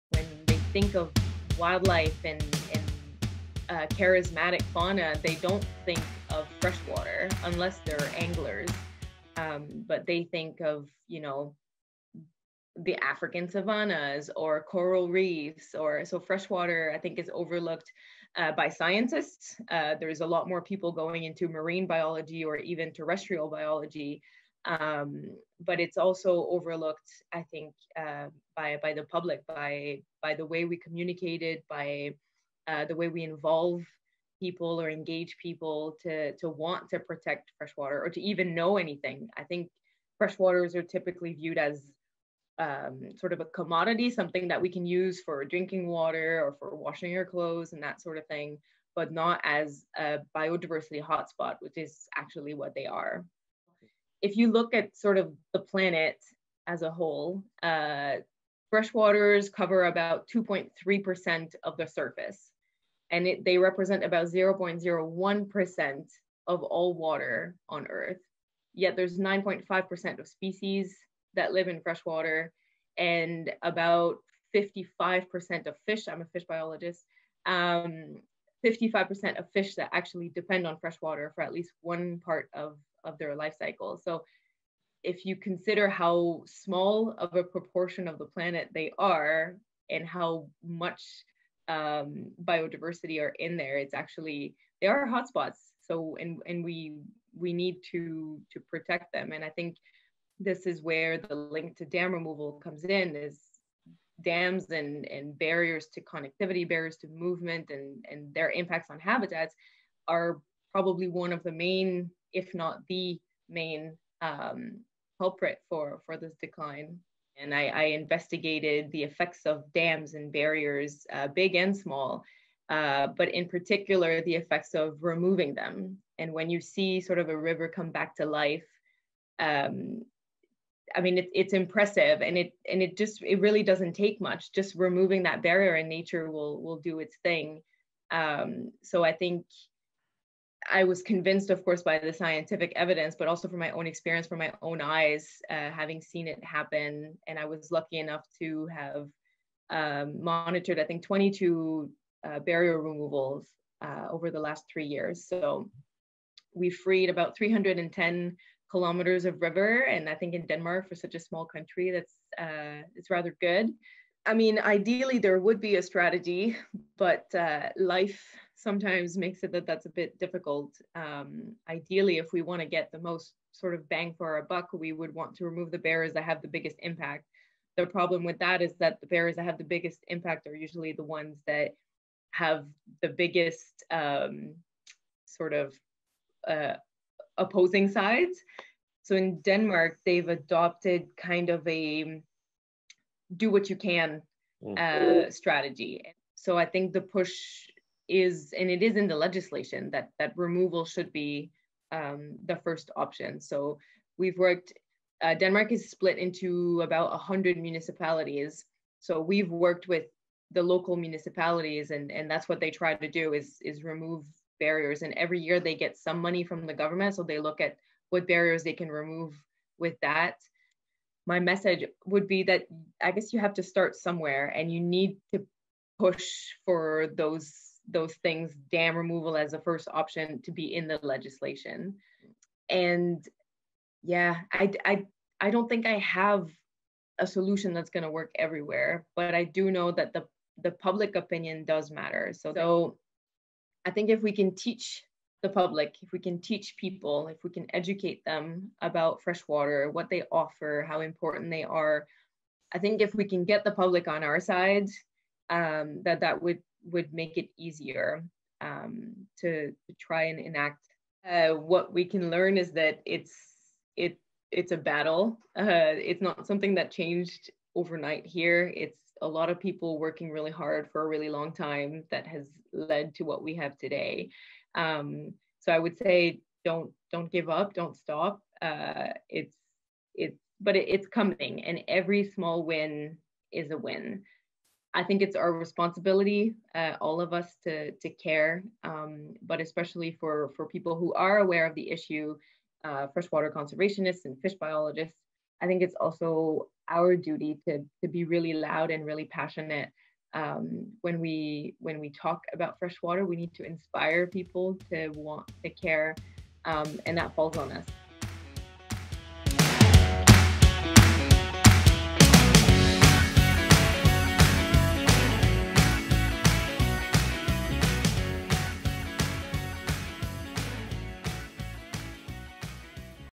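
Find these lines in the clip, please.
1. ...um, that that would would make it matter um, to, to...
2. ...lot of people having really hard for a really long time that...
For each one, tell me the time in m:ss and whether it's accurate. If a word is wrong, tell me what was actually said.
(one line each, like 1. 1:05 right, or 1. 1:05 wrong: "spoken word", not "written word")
1. 4:15 wrong: "easier", not "matter"
2. 4:29 wrong: "working", not "having".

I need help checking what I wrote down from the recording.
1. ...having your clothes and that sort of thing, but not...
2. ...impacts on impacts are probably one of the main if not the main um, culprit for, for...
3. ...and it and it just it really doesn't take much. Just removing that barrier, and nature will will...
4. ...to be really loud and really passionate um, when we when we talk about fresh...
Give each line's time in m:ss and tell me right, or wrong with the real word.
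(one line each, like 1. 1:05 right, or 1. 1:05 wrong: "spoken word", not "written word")
1. 0:46 wrong: "washing", not "having"
2. 1:48 wrong: "habitats", not "impacts"
3. 2:12 right
4. 4:58 right.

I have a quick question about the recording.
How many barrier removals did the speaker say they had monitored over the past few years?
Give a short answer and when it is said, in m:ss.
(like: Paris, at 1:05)
22, at 2:31.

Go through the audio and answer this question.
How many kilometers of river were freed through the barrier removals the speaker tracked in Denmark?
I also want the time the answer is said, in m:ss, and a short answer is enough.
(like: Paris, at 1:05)
310, at 2:37.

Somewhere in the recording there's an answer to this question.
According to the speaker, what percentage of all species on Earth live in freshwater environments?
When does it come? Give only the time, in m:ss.
1:09.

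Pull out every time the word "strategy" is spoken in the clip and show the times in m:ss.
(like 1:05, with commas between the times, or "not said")
2:45, 3:15.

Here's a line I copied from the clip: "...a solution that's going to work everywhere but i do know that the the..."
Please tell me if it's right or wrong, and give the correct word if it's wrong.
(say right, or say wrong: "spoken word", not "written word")
right.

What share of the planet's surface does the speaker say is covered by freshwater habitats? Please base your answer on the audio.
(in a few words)
2.3%.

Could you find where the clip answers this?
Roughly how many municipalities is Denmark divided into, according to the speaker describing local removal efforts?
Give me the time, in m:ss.
3:27.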